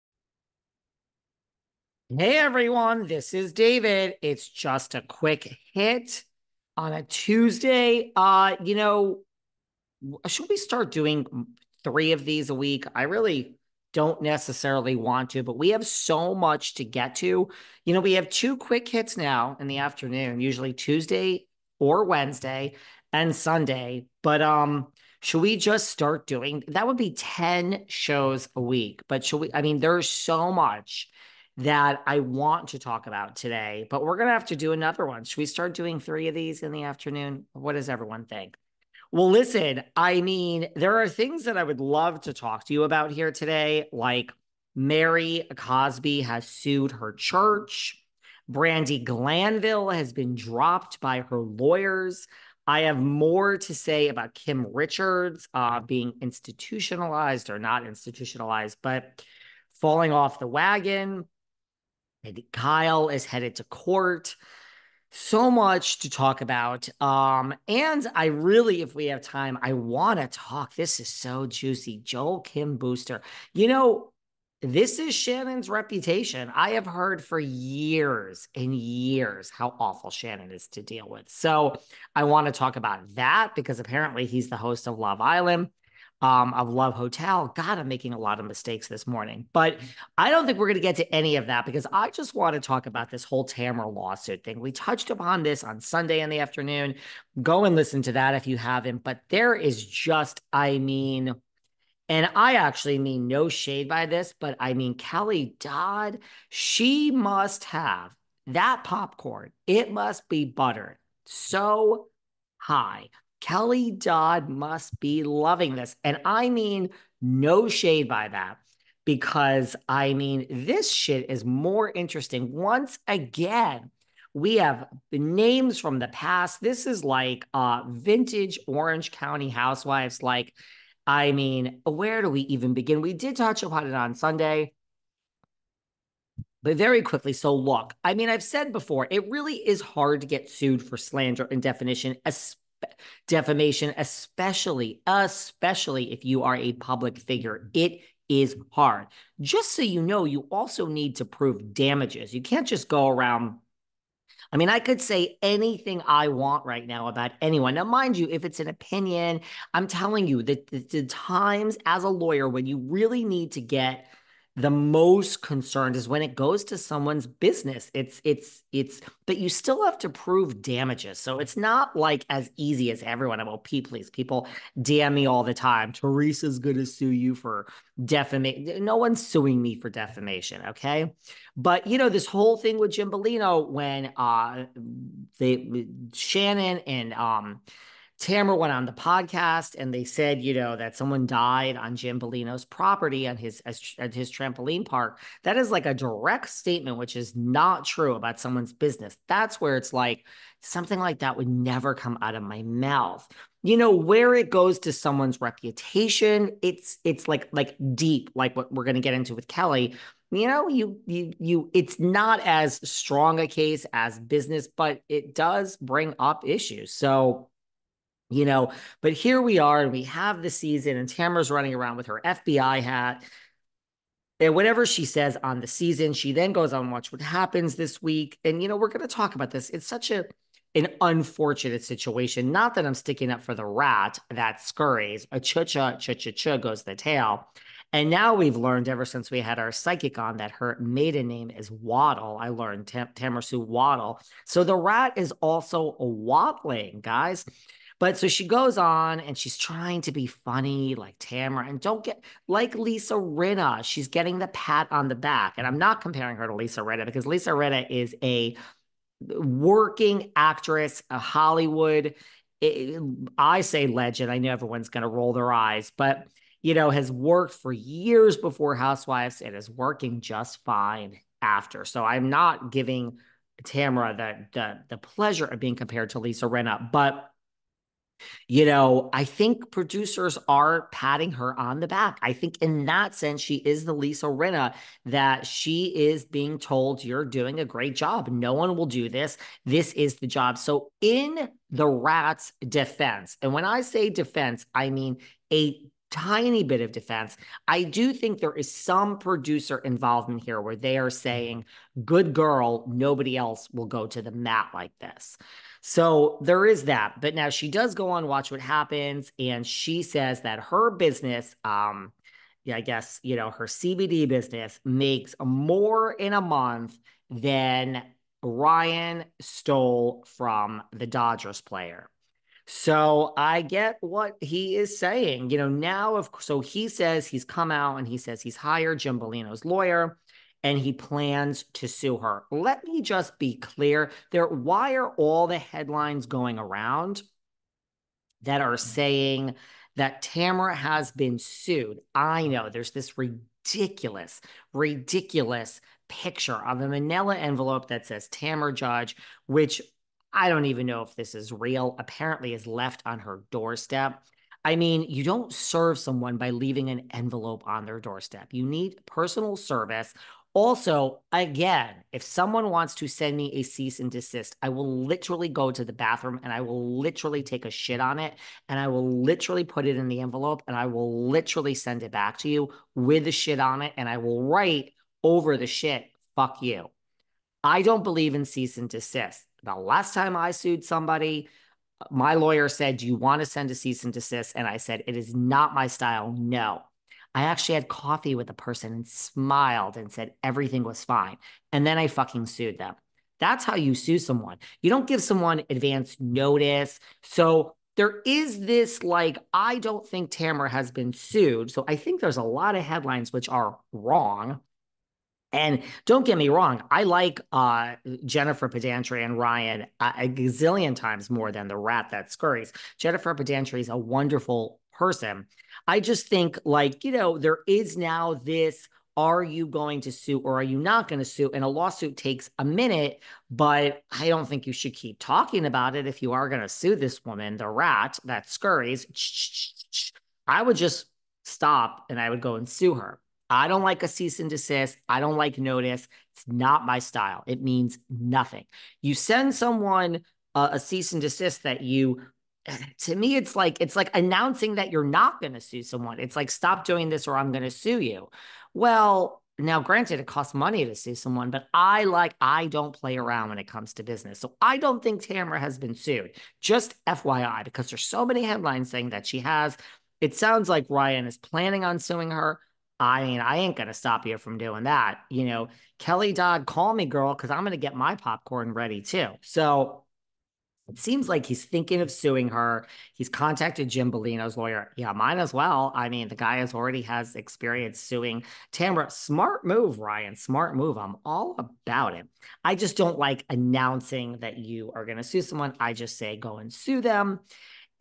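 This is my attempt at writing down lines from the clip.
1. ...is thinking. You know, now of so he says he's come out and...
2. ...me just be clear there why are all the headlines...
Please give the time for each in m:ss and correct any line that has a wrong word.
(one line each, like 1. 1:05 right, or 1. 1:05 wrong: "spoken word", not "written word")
1. 5:24 wrong: "saying", not "thinking"
2. 5:32 right.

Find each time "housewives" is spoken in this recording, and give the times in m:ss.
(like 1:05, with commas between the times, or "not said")
2:09, 4:28.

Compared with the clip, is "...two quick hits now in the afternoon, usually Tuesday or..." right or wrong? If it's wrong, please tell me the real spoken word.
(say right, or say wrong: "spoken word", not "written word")
right.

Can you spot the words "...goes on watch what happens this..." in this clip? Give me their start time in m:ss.
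3:46.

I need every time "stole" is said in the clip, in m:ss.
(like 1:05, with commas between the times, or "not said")
5:19.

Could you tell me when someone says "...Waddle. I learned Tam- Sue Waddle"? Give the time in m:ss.
4:01.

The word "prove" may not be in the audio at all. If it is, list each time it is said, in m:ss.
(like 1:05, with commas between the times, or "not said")
2:31, 2:50.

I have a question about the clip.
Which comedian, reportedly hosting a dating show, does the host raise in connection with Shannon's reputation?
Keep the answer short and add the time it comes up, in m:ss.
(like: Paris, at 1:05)
Joel Kim Booster, at 1:11.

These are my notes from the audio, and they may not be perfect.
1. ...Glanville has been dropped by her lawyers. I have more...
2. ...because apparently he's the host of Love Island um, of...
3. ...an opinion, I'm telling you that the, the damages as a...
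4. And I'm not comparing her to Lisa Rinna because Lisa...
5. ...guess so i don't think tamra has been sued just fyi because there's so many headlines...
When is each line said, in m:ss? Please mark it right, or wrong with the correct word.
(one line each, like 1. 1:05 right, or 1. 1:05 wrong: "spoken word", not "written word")
1. 0:49 right
2. 1:23 right
3. 2:38 wrong: "times", not "damages"
4. 4:15 right
5. 7:34 wrong: "business", not "guess".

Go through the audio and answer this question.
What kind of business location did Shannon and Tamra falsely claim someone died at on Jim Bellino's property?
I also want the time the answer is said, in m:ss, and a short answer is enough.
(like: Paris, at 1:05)
trampoline park, at 3:14.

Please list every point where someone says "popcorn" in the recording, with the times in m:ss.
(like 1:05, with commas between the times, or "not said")
1:48, 7:48.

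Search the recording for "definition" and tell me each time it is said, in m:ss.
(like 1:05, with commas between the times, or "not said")
2:21.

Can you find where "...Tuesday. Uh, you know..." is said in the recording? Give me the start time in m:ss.
0:07.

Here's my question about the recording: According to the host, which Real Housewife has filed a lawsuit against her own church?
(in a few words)
Mary Cosby.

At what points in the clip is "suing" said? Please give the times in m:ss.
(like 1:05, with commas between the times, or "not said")
2:59, 7:41, 7:52, 7:57.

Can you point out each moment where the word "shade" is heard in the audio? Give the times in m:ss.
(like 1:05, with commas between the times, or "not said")
1:43, 1:57.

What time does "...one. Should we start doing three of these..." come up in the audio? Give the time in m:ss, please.
0:35.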